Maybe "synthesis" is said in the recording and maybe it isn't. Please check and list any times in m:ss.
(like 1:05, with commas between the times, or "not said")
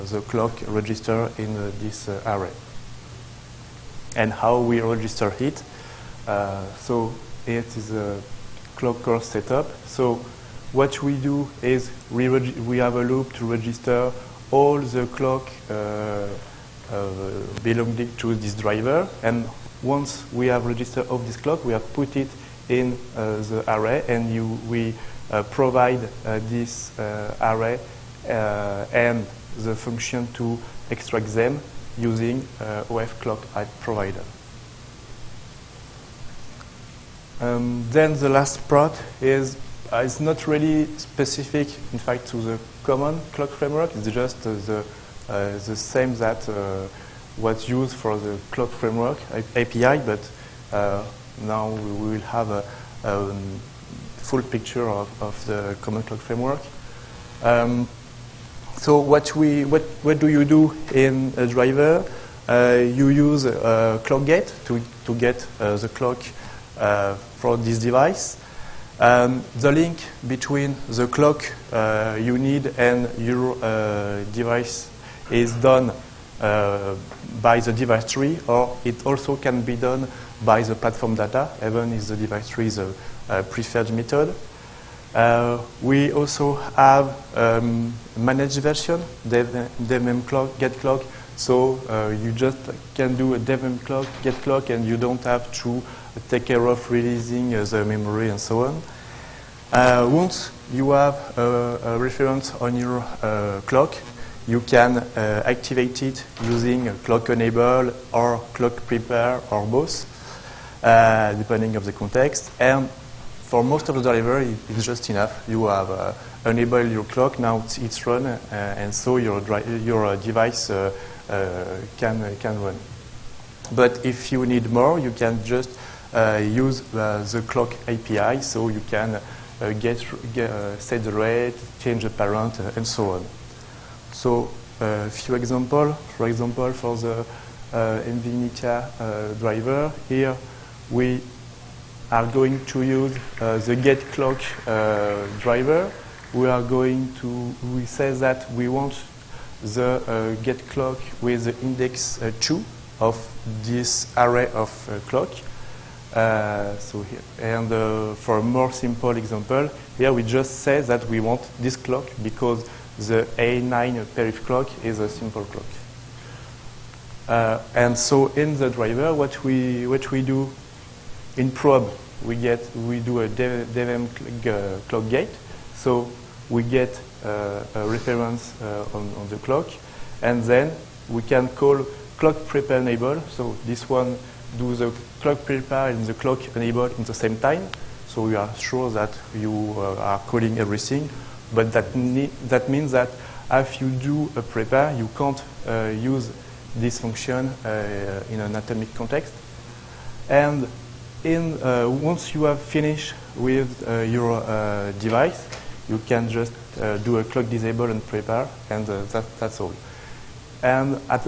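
not said.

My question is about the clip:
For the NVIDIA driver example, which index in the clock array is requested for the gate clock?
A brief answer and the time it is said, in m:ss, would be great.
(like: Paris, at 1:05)
2, at 2:32.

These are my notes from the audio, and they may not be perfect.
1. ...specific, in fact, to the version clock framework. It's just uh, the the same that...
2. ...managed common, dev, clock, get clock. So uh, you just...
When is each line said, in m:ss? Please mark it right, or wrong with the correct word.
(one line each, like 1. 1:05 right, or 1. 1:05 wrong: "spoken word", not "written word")
1. 0:40 wrong: "common", not "version"
2. 1:28 wrong: "version", not "common".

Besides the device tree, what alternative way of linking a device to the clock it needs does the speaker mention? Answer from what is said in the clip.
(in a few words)
platform data.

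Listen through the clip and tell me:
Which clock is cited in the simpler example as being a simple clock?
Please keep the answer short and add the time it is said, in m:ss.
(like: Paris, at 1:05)
A9 perif clock, at 2:43.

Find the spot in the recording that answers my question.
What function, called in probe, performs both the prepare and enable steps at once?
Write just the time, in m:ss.
3:02.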